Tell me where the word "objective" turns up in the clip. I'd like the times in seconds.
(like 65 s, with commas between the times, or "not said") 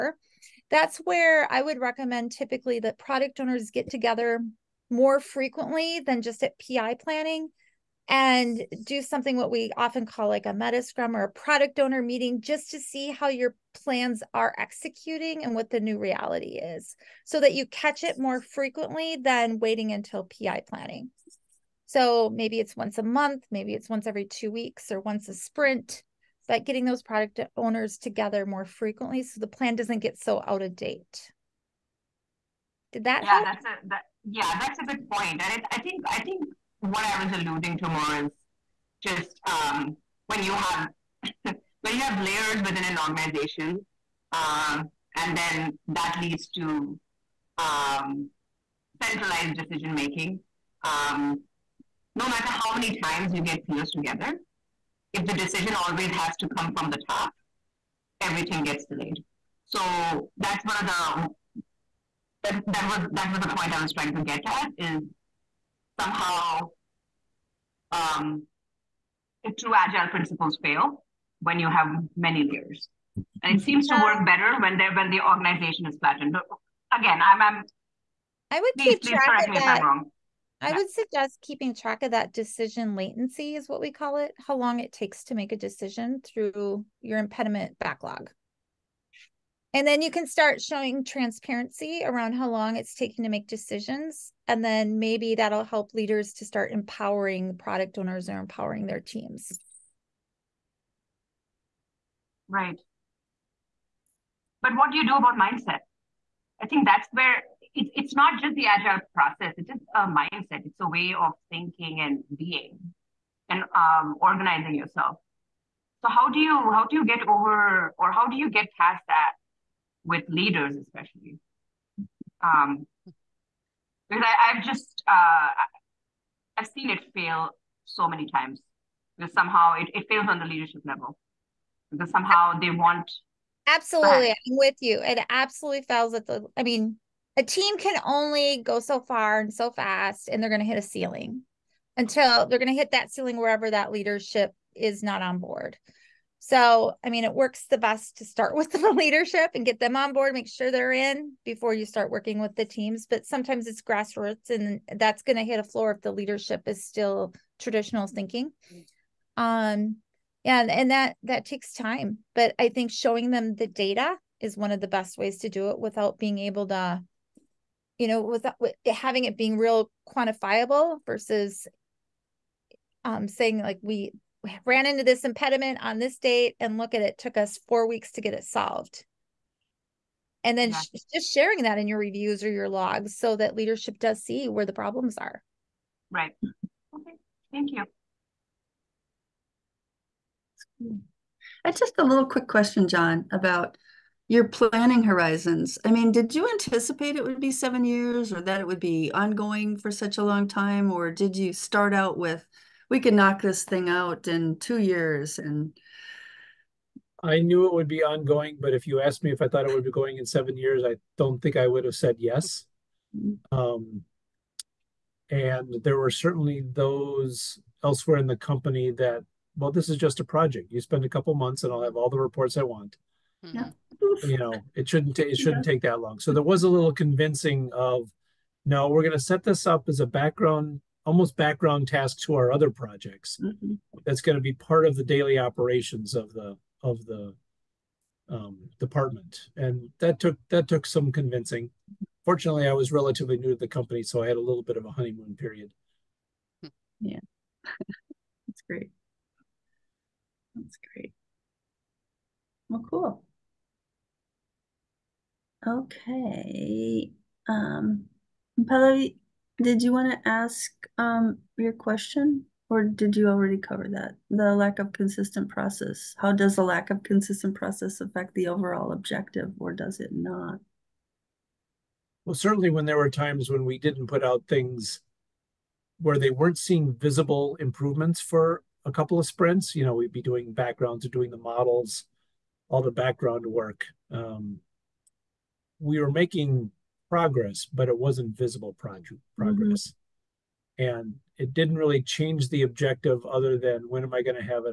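268 s, 292 s.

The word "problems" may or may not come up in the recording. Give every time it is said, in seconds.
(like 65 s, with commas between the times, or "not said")
184 s.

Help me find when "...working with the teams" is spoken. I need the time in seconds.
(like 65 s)
152 s.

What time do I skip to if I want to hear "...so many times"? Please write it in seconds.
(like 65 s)
127 s.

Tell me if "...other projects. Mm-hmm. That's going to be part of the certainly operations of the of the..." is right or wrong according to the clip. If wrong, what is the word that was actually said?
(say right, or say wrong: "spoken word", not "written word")
wrong: "daily", not "certainly".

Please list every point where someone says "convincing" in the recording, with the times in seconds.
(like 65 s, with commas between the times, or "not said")
226 s, 241 s.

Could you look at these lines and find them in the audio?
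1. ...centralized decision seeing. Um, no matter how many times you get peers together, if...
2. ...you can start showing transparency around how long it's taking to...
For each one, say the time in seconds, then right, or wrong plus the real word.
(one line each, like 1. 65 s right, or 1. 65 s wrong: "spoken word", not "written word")
1. 49 s wrong: "making", not "seeing"
2. 90 s right.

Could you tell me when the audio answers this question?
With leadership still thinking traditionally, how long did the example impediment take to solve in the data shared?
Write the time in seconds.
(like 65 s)
177 s.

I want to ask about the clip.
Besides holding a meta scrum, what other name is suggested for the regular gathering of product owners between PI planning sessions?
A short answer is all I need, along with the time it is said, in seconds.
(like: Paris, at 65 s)
product owner meeting, at 11 s.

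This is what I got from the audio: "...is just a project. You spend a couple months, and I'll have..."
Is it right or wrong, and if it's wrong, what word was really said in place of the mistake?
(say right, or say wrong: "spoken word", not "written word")
right.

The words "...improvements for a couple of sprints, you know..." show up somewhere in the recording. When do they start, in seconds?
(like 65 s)
277 s.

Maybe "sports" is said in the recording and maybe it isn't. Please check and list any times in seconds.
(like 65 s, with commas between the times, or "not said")
not said.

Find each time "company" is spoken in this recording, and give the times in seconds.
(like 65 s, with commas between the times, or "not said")
218 s, 243 s.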